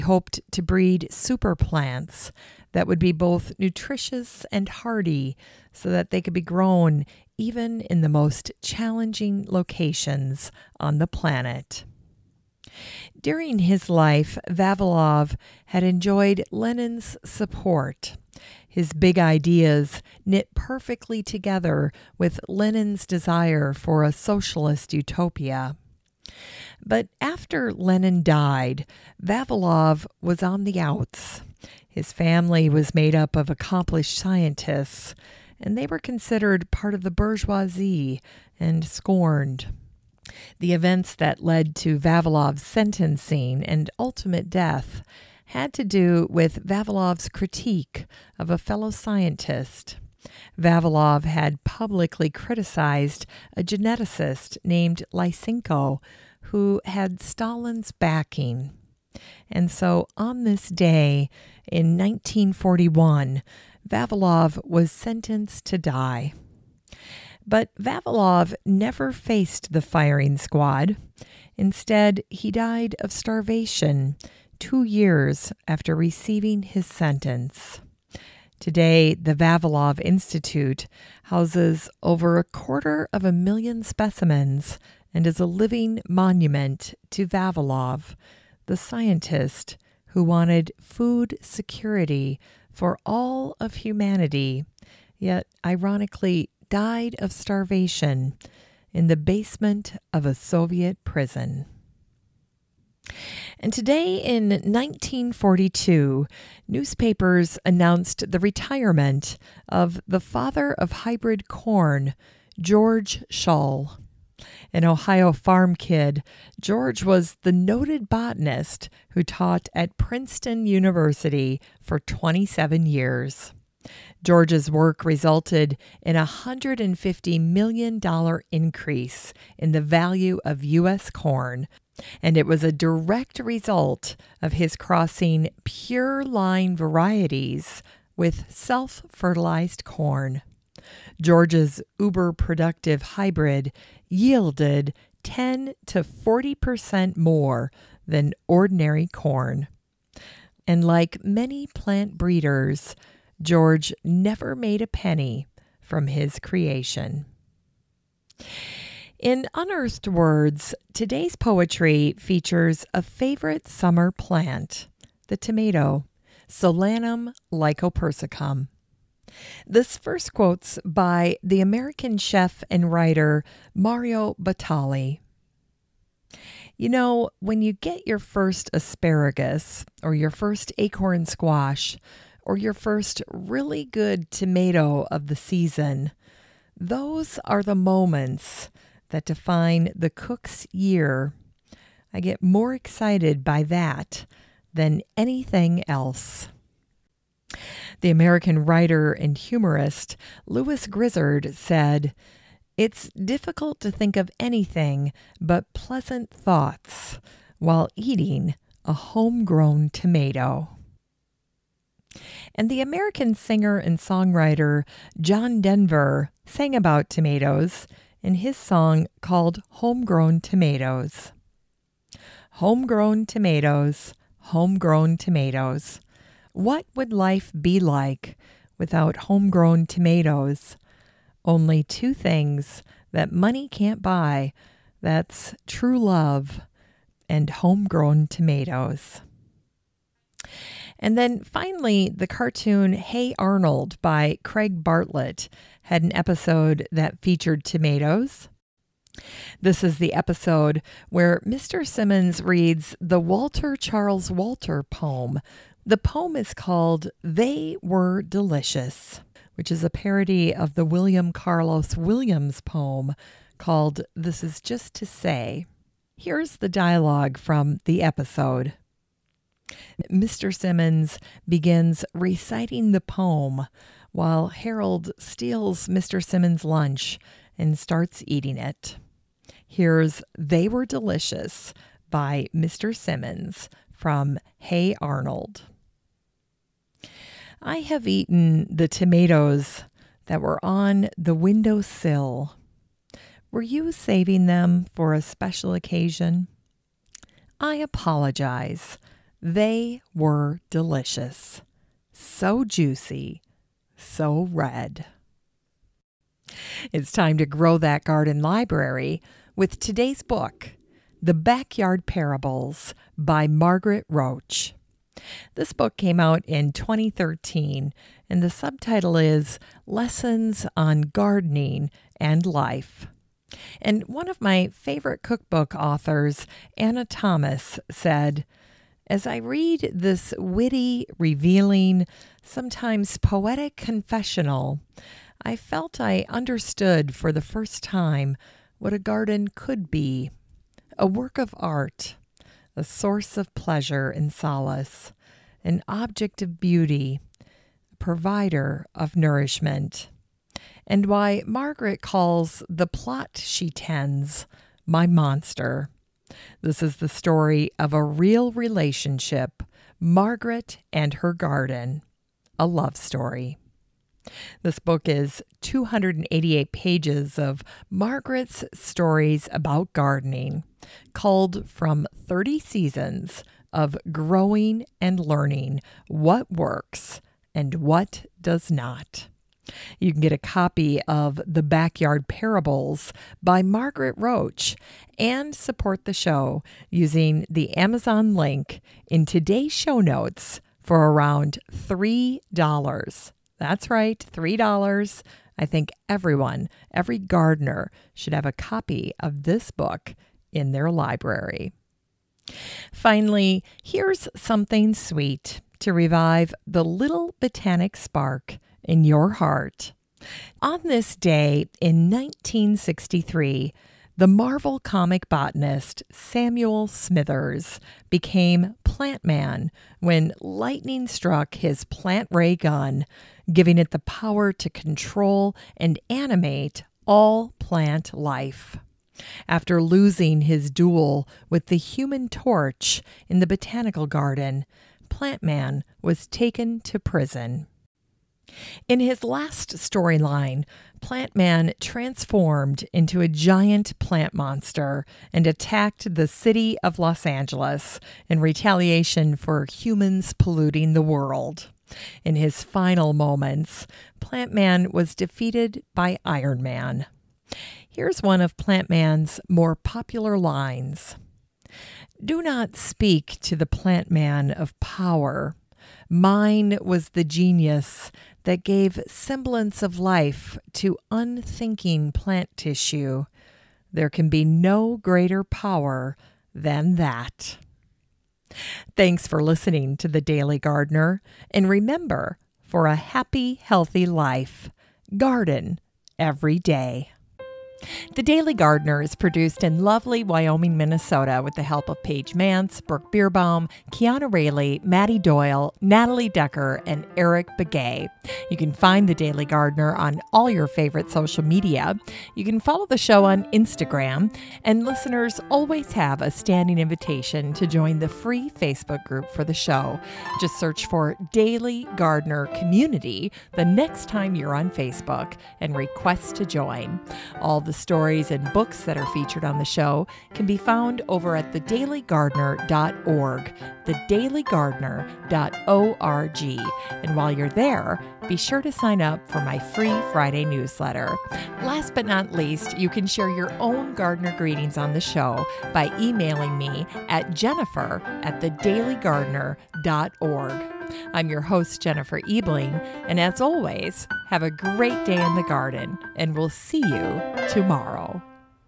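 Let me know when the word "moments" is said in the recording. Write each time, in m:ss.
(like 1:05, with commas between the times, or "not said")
3:07, 7:33.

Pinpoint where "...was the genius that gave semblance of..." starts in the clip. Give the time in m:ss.
7:46.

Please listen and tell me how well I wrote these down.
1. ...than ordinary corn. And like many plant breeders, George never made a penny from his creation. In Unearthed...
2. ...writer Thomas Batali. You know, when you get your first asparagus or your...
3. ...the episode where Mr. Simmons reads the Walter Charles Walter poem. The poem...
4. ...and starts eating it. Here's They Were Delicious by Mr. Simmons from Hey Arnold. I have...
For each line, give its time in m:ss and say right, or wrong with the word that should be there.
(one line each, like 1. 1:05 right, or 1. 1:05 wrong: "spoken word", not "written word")
1. 2:28 right
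2. 2:52 wrong: "Mario", not "Thomas"
3. 4:09 right
4. 4:37 right.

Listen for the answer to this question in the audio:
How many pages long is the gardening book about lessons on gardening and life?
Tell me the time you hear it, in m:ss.
6:05.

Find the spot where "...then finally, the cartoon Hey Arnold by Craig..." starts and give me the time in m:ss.
4:01.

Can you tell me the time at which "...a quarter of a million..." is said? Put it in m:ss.
1:22.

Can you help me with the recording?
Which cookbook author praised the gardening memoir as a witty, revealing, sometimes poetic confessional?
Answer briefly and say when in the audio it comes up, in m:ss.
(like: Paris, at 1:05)
Anna Thomas, at 5:26.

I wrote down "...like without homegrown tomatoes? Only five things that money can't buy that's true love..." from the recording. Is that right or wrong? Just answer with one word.
wrong.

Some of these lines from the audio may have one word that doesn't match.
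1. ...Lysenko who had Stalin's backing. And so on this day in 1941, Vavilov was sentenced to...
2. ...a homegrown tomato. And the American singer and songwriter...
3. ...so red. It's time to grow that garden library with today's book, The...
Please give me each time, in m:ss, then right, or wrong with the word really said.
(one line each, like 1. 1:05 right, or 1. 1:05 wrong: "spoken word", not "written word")
1. 0:55 right
2. 3:28 right
3. 5:04 right.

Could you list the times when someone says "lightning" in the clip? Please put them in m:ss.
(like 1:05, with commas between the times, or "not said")
7:00.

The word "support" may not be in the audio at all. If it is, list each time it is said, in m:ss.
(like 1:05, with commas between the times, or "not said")
0:17, 6:25.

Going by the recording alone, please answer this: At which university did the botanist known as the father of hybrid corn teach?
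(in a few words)
Princeton University.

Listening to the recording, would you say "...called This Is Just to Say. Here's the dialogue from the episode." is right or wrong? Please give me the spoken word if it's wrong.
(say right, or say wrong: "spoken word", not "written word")
right.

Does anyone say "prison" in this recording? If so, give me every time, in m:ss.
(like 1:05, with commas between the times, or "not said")
1:41, 7:16.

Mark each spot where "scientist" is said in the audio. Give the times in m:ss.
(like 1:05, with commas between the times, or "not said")
0:34, 0:48, 1:28.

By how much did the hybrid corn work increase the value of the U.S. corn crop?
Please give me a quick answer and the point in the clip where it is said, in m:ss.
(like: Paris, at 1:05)
$150 million, at 2:06.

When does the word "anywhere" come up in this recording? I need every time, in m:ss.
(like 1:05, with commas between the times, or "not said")
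not said.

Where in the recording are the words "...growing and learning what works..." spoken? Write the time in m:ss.
6:14.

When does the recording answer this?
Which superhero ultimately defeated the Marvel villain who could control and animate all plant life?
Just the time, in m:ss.
7:36.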